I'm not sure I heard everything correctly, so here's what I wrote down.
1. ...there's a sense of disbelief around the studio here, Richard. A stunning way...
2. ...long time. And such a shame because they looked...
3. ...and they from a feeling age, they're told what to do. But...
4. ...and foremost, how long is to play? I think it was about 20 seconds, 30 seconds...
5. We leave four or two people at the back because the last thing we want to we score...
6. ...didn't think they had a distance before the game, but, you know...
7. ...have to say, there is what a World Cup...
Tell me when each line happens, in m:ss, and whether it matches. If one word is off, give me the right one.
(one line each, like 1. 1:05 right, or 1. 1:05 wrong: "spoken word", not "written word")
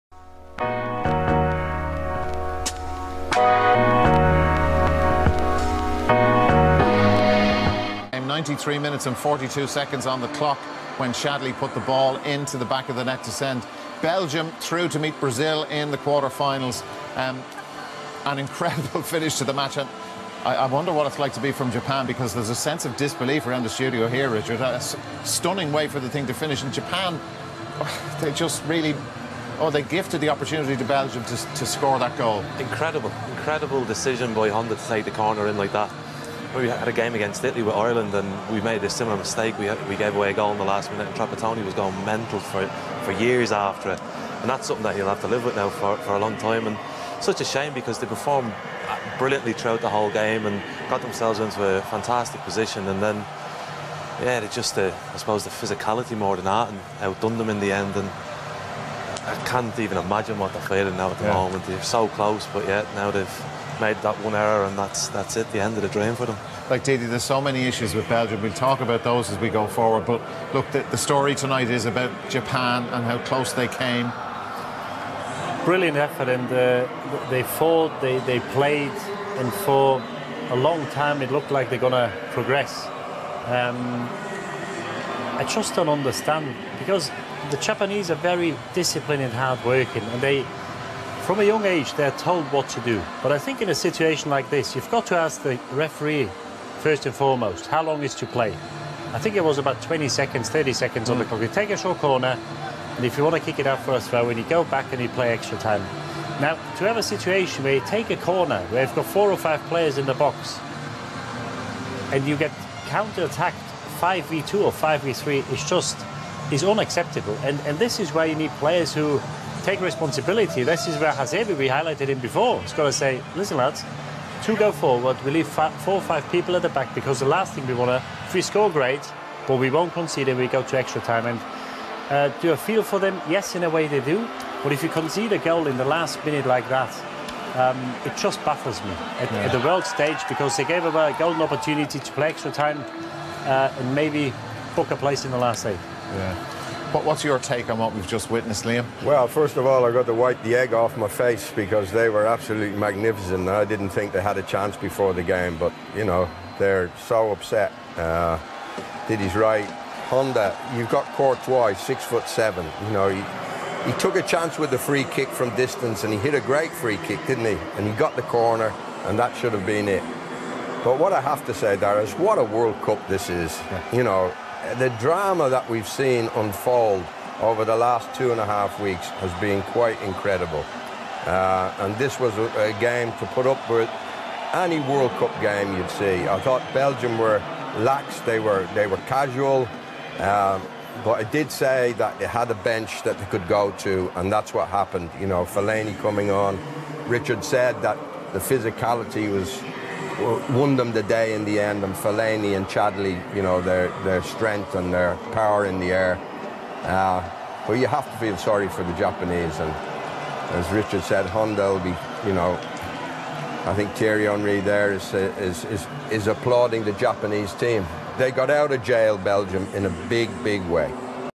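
1. 0:22 right
2. 0:46 wrong: "performed", not "looked"
3. 1:30 wrong: "young", not "feeling"
4. 1:37 right
5. 2:05 wrong: "five", not "two"
6. 2:33 wrong: "chance", not "distance"
7. 2:51 right.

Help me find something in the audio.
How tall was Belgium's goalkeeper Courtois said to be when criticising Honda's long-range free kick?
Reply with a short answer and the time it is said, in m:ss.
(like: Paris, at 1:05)
6 foot 7, at 2:41.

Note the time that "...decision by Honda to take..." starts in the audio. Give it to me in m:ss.
0:33.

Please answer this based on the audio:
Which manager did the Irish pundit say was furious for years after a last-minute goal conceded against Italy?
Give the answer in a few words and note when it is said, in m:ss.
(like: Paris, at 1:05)
Trapattoni, at 0:41.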